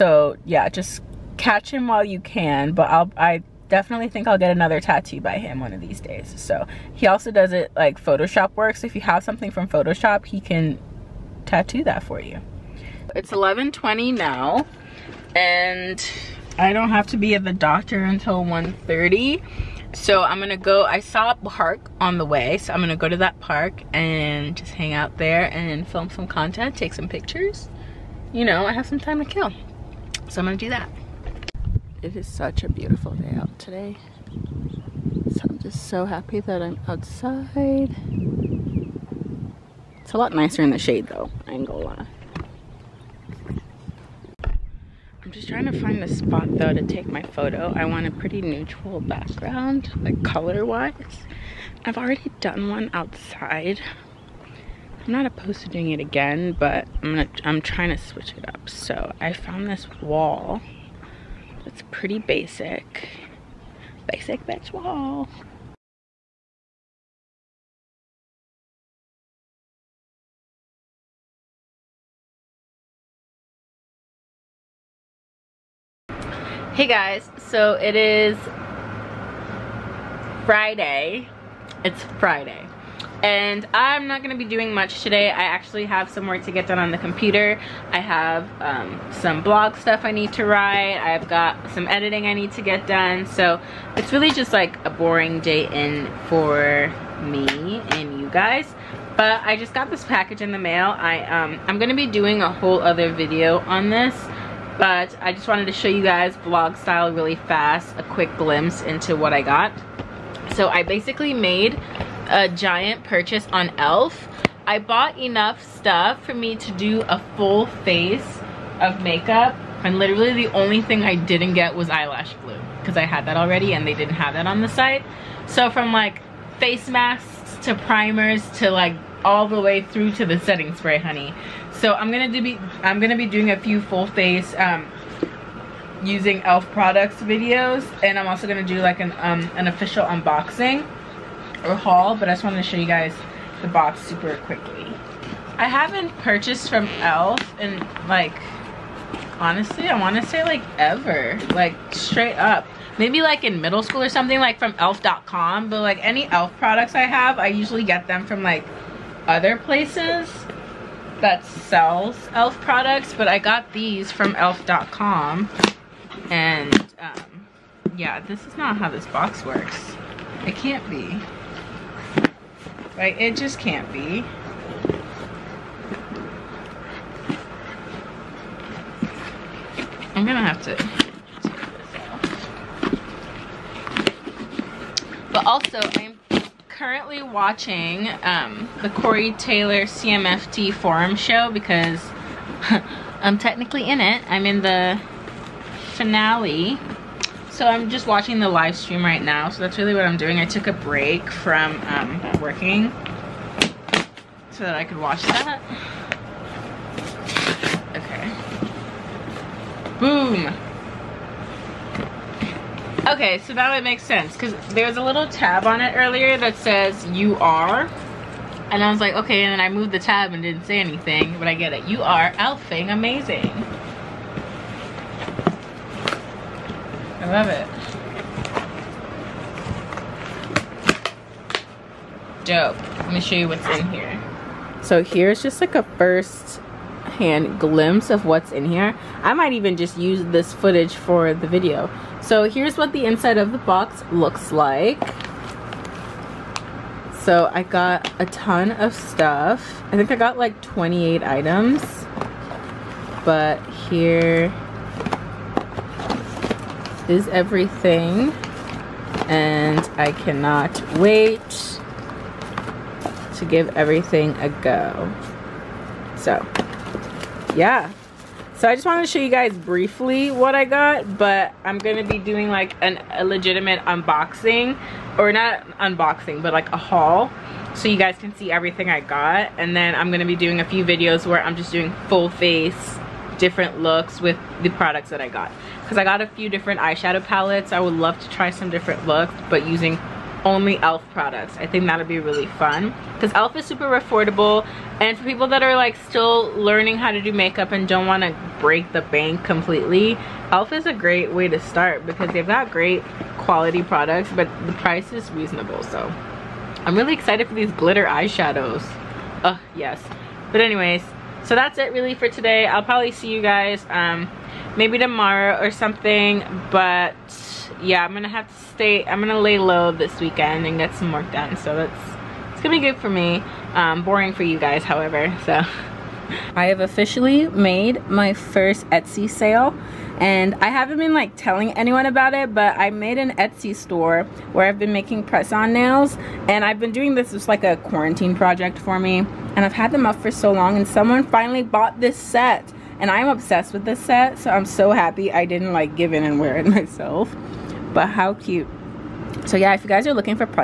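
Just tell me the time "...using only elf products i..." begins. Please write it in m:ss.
4:49.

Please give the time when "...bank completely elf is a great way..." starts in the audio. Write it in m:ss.
4:59.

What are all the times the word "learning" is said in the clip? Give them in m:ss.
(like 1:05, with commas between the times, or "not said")
4:56.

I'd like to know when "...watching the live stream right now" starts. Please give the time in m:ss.
3:18.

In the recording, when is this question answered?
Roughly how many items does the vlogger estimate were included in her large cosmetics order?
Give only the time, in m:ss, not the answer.
4:10.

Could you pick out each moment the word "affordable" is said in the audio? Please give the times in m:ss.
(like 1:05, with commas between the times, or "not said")
4:53.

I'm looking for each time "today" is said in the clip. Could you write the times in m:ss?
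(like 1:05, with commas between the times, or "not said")
0:33, 1:25, 5:12.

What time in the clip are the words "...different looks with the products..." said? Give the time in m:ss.
4:43.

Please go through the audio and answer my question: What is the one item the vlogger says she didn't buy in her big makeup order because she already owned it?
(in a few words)
Eyelash glue.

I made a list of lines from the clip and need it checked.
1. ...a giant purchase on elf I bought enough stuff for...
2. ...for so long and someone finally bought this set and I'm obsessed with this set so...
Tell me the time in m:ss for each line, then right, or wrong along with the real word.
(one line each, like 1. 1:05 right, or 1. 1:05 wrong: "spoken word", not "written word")
1. 1:52 right
2. 5:40 right.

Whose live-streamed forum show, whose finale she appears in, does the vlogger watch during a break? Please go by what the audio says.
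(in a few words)
Corey Taylor.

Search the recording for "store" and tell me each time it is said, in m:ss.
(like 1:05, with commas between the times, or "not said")
5:33.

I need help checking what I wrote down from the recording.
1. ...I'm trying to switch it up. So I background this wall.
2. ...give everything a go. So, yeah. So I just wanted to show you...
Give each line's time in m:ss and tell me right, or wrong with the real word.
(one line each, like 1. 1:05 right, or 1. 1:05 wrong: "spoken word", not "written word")
1. 0:57 wrong: "found", not "background"
2. 4:23 right.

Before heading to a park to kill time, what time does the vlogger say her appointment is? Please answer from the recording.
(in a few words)
1:30.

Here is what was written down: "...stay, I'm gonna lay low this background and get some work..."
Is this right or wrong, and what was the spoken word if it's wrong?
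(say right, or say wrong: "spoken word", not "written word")
wrong: "weekend", not "background".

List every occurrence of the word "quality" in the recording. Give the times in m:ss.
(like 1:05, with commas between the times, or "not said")
5:03.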